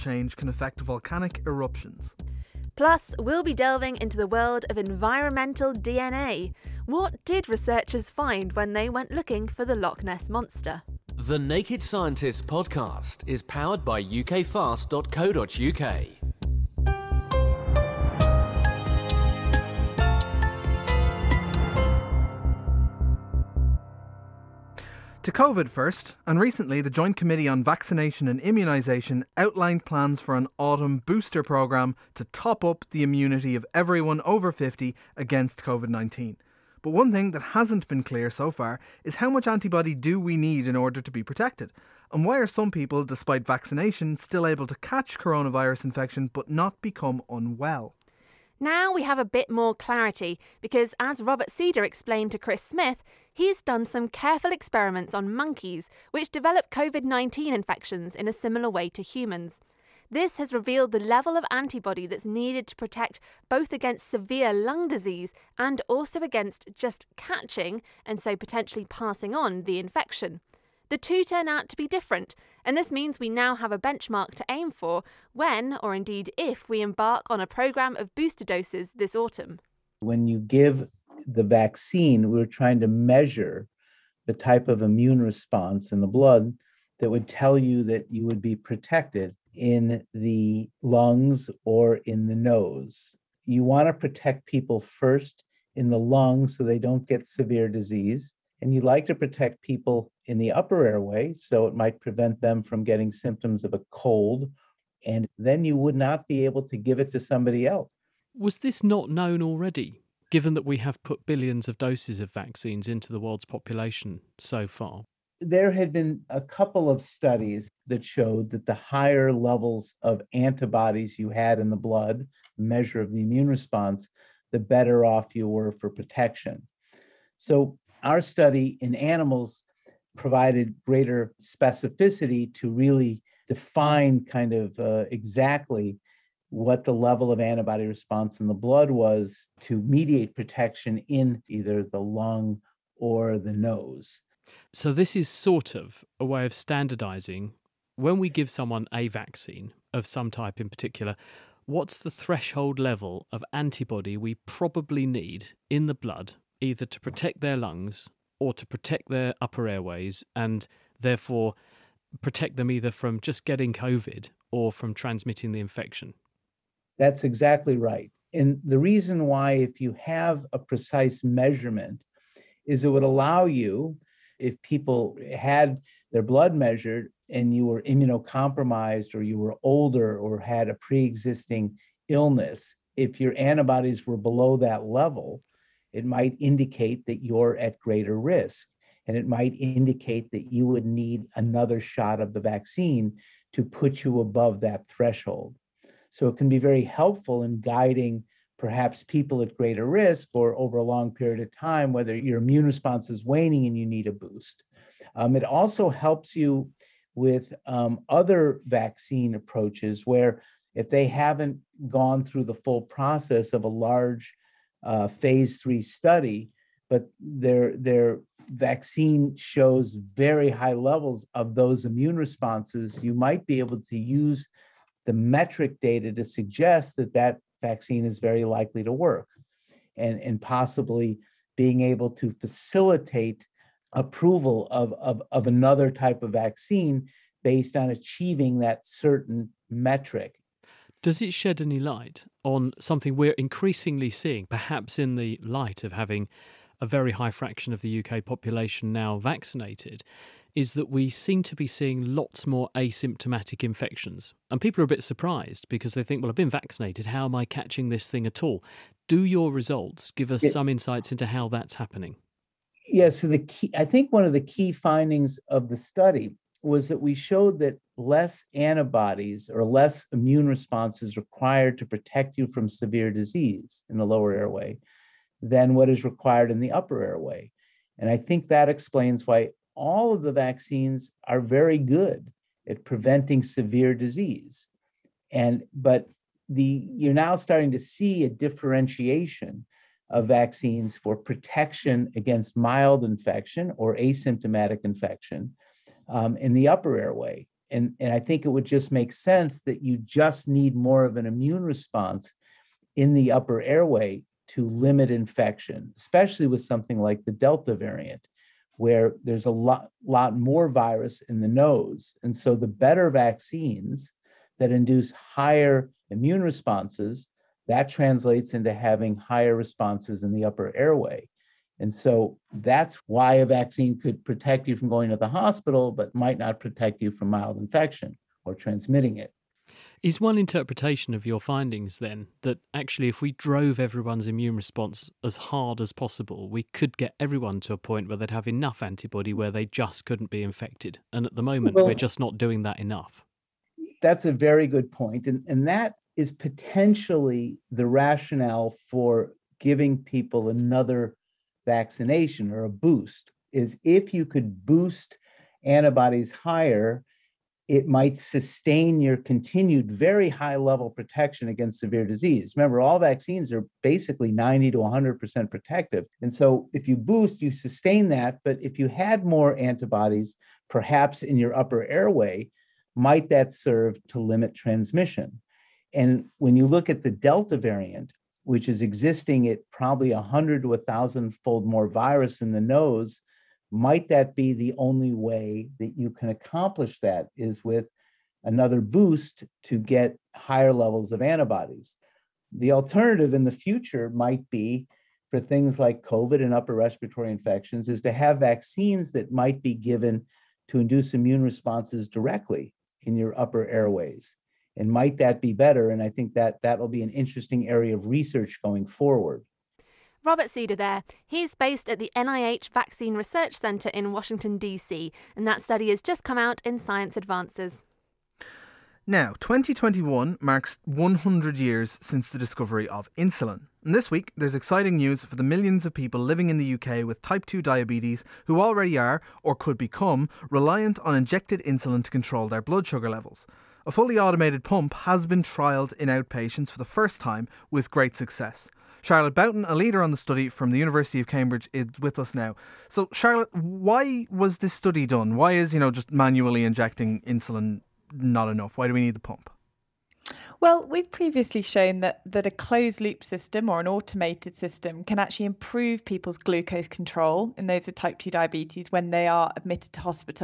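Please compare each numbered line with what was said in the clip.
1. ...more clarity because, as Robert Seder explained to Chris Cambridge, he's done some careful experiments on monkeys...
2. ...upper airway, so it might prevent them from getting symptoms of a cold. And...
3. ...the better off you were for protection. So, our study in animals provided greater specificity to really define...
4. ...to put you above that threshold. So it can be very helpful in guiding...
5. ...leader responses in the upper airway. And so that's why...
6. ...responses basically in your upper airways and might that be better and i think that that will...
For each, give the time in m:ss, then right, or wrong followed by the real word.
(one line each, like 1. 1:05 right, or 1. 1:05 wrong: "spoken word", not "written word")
1. 0:49 wrong: "Smith", not "Cambridge"
2. 1:40 right
3. 2:04 right
4. 3:13 right
5. 5:19 wrong: "higher", not "leader"
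6. 6:41 wrong: "directly", not "basically".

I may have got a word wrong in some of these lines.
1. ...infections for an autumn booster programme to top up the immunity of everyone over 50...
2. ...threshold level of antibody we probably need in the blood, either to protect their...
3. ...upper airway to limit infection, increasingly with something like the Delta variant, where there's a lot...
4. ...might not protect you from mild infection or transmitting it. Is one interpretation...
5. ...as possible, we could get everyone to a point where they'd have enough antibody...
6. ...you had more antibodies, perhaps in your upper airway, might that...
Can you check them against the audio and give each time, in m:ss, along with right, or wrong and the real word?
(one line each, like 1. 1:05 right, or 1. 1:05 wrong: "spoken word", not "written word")
1. 0:29 wrong: "plans", not "infections"
2. 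2:32 right
3. 5:03 wrong: "especially", not "increasingly"
4. 5:26 right
5. 5:35 right
6. 6:08 right.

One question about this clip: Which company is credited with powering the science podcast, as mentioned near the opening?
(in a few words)
ukfast.co.uk.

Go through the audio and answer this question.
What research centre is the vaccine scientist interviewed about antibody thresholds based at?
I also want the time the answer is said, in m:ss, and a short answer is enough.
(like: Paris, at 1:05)
NIH Vaccine Research Center, at 6:52.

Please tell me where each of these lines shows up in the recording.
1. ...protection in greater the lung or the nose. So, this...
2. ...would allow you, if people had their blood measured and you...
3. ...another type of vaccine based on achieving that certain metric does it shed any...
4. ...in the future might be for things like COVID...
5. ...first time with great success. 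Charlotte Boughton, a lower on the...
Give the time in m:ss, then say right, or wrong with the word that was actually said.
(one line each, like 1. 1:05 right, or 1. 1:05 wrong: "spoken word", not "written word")
1. 2:20 wrong: "either", not "greater"
2. 2:52 right
3. 3:55 right
4. 6:33 right
5. 7:16 wrong: "leader", not "lower".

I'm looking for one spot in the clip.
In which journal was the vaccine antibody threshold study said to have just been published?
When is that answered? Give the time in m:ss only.
6:56.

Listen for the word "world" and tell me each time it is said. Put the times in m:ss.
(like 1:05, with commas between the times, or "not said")
0:04, 1:53.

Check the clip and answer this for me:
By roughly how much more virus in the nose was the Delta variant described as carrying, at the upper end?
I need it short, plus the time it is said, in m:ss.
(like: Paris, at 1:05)
1,000 fold, at 6:20.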